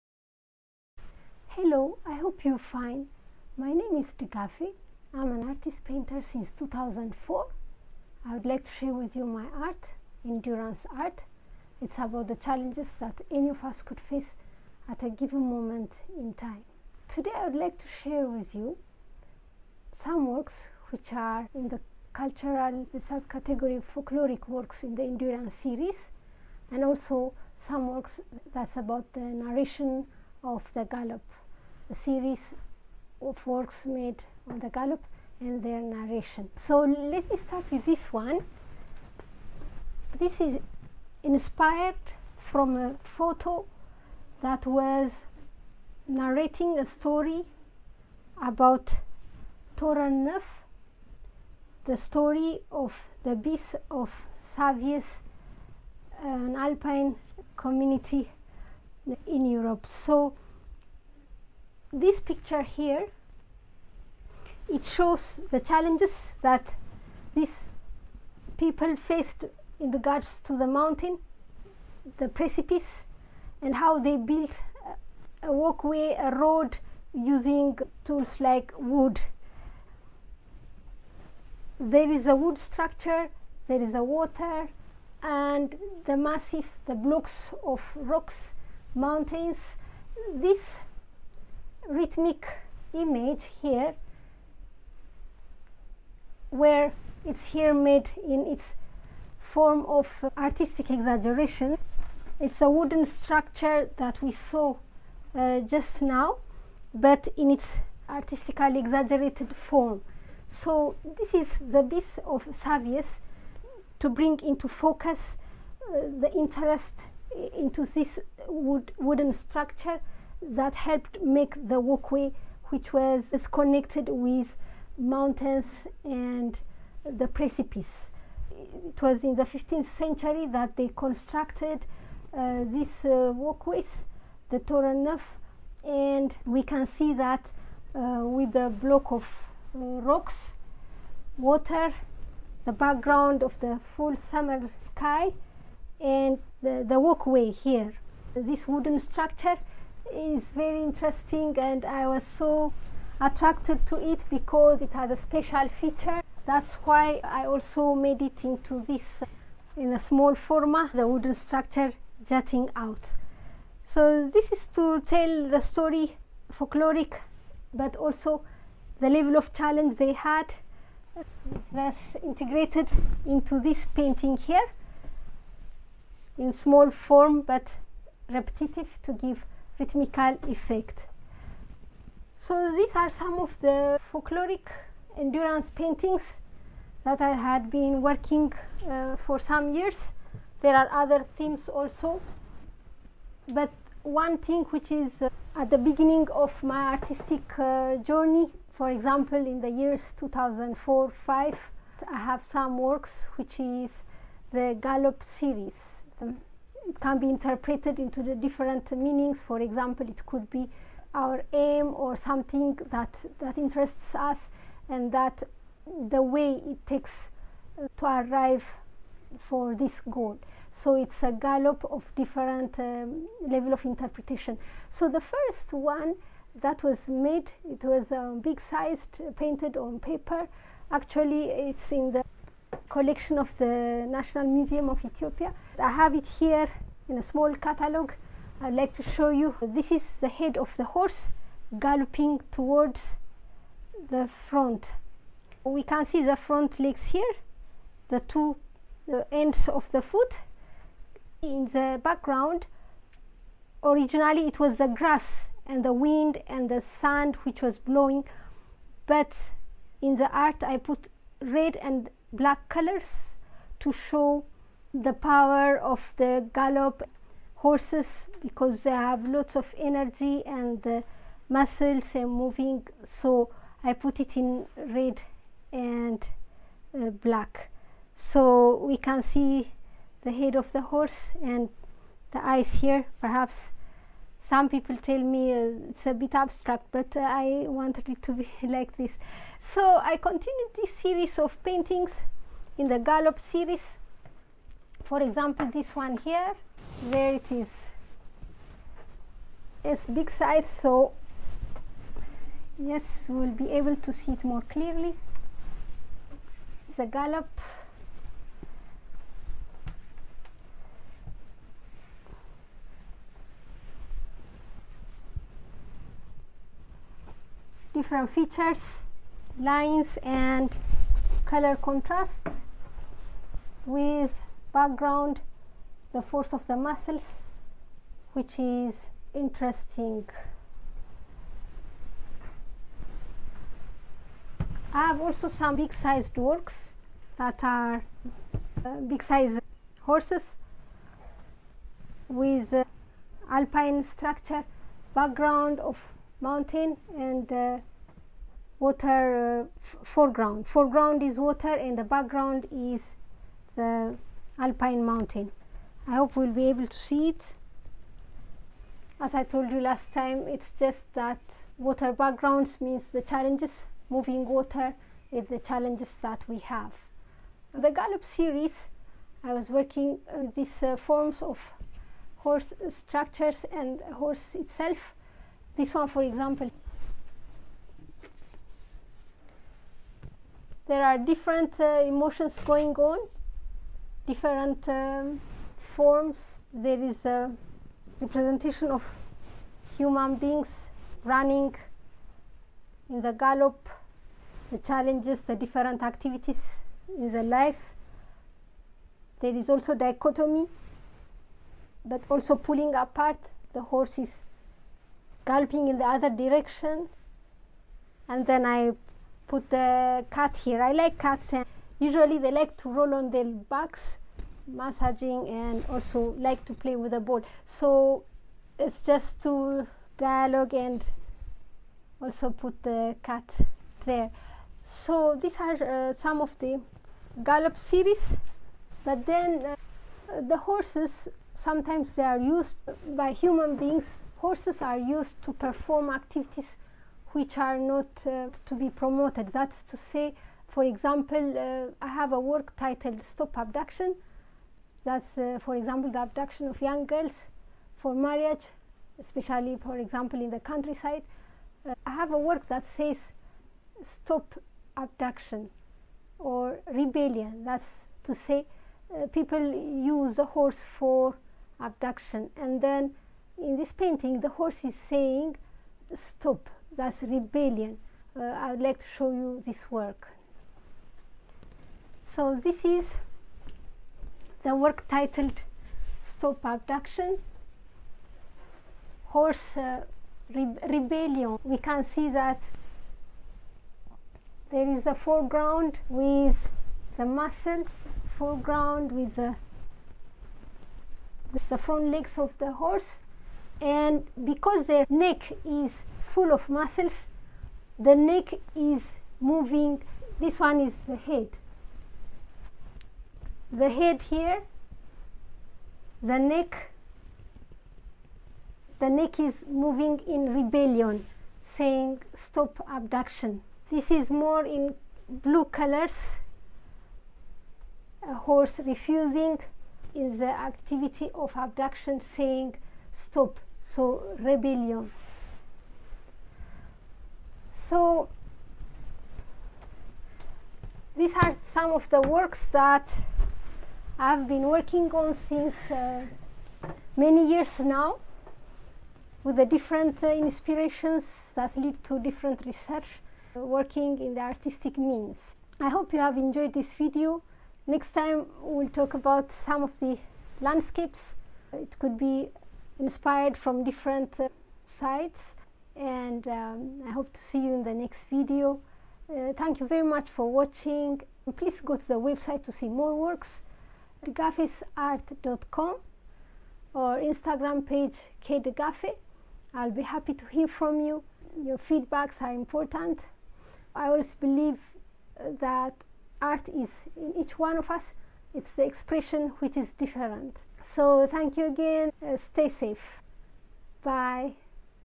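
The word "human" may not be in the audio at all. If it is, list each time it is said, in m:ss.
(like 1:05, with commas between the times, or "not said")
6:29, 7:13.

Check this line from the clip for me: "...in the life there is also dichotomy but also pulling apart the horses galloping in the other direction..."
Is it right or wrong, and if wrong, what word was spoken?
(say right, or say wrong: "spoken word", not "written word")
right.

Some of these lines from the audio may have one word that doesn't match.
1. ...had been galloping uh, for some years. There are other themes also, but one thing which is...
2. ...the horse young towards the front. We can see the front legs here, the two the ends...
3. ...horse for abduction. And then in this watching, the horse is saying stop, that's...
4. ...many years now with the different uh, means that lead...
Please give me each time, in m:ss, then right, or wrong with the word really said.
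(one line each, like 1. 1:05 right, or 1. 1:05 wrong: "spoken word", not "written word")
1. 3:07 wrong: "working", not "galloping"
2. 4:00 wrong: "galloping", not "young"
3. 7:40 wrong: "painting", not "watching"
4. 8:57 wrong: "inspirations", not "means".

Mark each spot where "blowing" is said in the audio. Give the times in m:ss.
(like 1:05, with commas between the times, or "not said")
4:17.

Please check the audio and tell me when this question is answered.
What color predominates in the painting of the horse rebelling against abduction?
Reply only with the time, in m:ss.
8:35.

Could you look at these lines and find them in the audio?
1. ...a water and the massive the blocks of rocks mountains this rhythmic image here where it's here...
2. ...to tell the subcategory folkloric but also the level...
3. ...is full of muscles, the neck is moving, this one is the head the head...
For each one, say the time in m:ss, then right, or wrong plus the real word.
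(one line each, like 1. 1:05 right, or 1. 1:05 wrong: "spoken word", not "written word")
1. 1:23 right
2. 2:44 wrong: "story", not "subcategory"
3. 8:15 right.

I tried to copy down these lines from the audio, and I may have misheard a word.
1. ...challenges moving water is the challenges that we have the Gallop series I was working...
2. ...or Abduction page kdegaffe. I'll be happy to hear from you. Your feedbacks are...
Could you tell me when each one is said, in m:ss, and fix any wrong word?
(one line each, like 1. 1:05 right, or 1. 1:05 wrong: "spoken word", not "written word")
1. 6:03 right
2. 9:26 wrong: "Instagram", not "Abduction".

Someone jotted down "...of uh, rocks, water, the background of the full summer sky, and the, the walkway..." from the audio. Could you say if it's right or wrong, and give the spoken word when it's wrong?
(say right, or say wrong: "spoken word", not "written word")
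right.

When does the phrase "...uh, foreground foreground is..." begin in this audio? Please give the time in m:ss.
5:49.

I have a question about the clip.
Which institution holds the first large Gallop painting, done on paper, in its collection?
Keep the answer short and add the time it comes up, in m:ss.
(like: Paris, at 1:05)
National Museum of Ethiopia, at 3:54.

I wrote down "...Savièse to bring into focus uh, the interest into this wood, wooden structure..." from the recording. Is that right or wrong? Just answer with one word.
right.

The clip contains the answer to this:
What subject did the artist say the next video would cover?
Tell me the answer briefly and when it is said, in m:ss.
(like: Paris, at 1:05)
Landscapes, at 9:10.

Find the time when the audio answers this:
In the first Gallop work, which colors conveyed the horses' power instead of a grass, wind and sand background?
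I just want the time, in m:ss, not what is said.
4:21.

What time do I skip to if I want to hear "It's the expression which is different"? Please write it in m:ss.
9:38.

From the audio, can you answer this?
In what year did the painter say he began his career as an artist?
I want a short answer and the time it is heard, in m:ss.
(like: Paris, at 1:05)
2004, at 0:06.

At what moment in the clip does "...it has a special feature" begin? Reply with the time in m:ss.
2:34.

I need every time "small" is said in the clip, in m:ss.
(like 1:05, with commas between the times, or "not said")
2:39, 2:56, 3:57.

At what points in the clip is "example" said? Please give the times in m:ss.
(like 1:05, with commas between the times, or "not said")
3:18, 3:29, 4:55, 6:16, 7:20, 7:25, 7:29.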